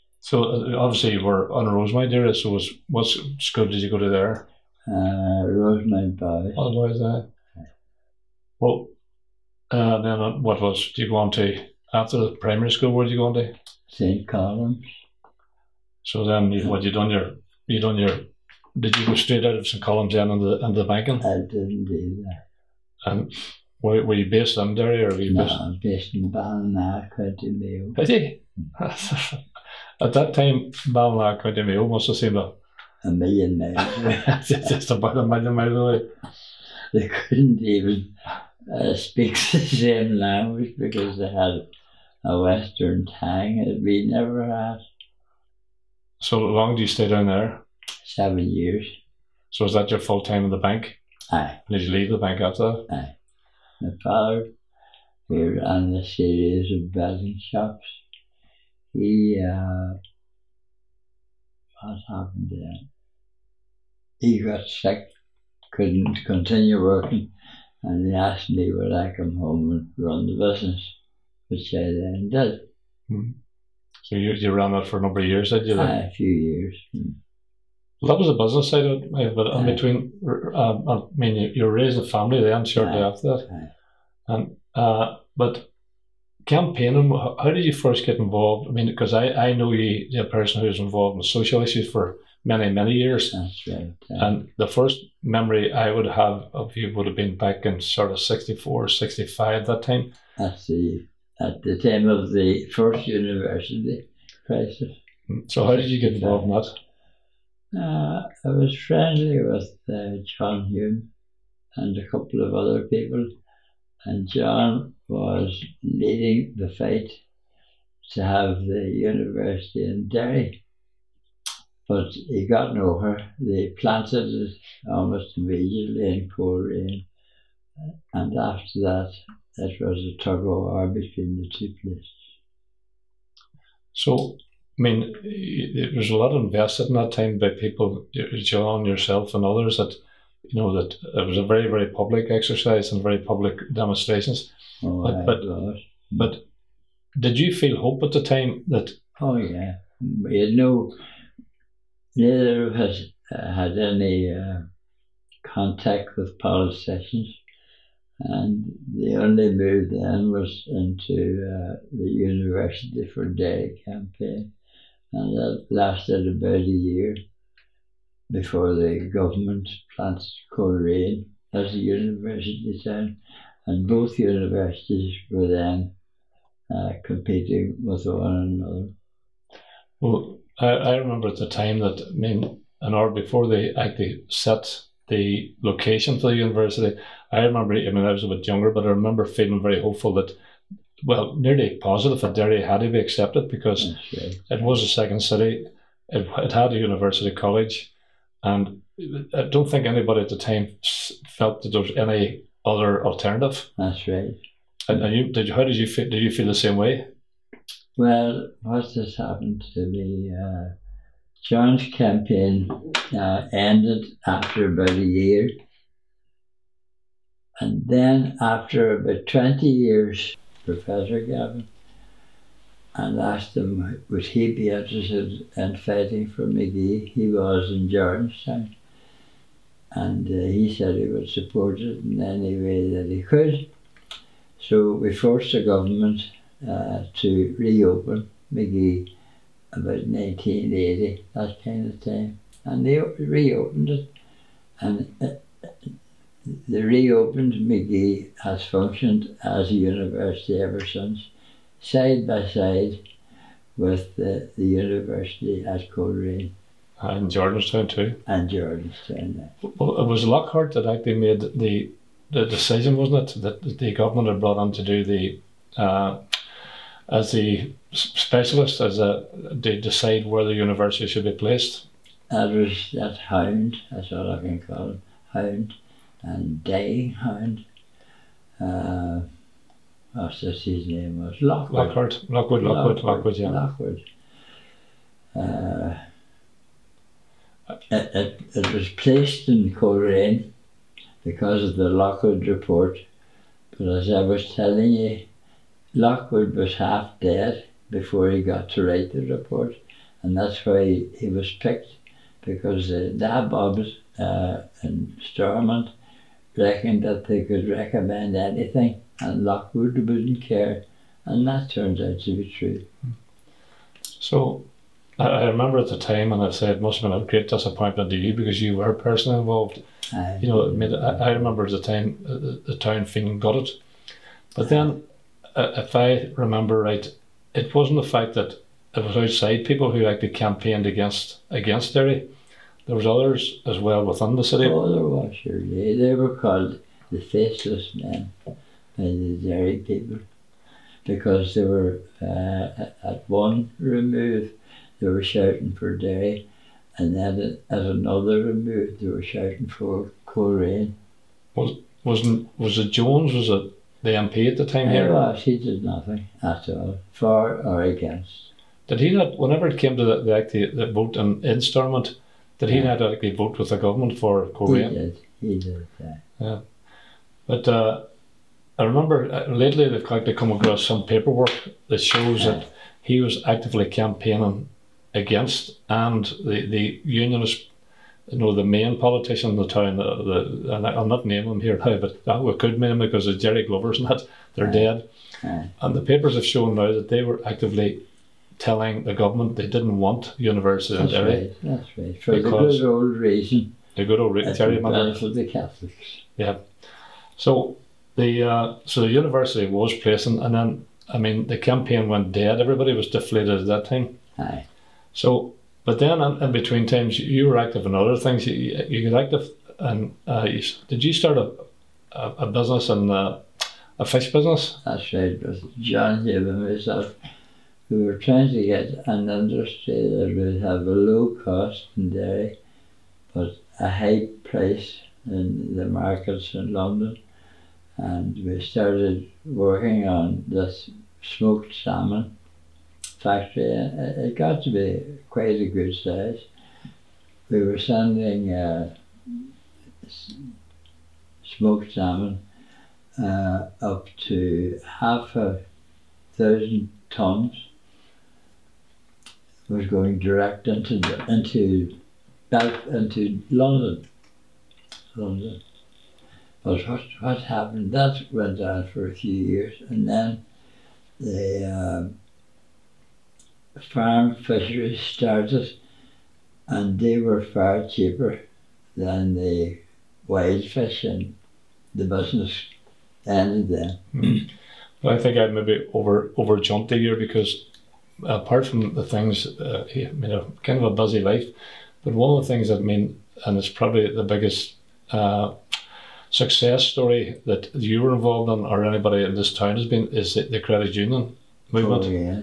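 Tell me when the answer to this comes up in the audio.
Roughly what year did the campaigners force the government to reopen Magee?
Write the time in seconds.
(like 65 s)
240 s.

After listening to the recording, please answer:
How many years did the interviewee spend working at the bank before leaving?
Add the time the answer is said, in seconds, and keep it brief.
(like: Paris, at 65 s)
7, at 48 s.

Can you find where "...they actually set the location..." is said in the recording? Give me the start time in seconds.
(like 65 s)
183 s.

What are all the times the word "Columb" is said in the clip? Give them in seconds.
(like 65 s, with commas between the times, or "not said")
14 s, 19 s.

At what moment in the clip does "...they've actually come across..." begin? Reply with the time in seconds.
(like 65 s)
369 s.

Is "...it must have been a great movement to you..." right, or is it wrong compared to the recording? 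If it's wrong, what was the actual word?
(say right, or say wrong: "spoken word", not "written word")
wrong: "disappointment", not "movement".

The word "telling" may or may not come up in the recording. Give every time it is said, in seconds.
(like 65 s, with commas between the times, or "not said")
294 s, 388 s.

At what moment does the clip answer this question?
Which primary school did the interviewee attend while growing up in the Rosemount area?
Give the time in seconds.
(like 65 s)
5 s.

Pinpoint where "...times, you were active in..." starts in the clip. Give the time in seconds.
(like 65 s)
406 s.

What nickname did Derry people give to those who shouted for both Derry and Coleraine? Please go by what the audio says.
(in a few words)
the faceless men.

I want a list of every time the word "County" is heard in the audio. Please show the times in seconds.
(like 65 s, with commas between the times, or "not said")
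27 s, 31 s.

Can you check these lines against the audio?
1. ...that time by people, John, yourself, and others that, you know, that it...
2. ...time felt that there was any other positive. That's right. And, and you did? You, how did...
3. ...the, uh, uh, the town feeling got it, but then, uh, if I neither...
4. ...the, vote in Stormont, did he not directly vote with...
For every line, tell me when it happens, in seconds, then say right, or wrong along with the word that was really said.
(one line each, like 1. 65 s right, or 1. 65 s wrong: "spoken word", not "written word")
1. 136 s right
2. 200 s wrong: "alternative", not "positive"
3. 322 s wrong: "remember", not "neither"
4. 360 s right.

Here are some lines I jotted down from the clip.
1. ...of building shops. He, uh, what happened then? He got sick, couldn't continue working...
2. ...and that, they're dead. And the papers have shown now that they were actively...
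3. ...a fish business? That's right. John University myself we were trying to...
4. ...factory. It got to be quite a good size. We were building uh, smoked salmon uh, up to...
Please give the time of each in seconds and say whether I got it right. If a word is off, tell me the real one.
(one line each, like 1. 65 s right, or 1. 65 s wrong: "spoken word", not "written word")
1. 56 s right
2. 383 s right
3. 413 s wrong: "Haven", not "University"
4. 433 s wrong: "sending", not "building".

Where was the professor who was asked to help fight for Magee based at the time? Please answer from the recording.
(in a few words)
Georgetown.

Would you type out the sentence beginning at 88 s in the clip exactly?
I mean, because I, I know you, you're a person who's involved in social issues for many, many years.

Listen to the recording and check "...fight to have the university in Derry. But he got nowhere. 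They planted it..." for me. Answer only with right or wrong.
right.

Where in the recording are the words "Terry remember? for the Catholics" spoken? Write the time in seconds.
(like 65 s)
394 s.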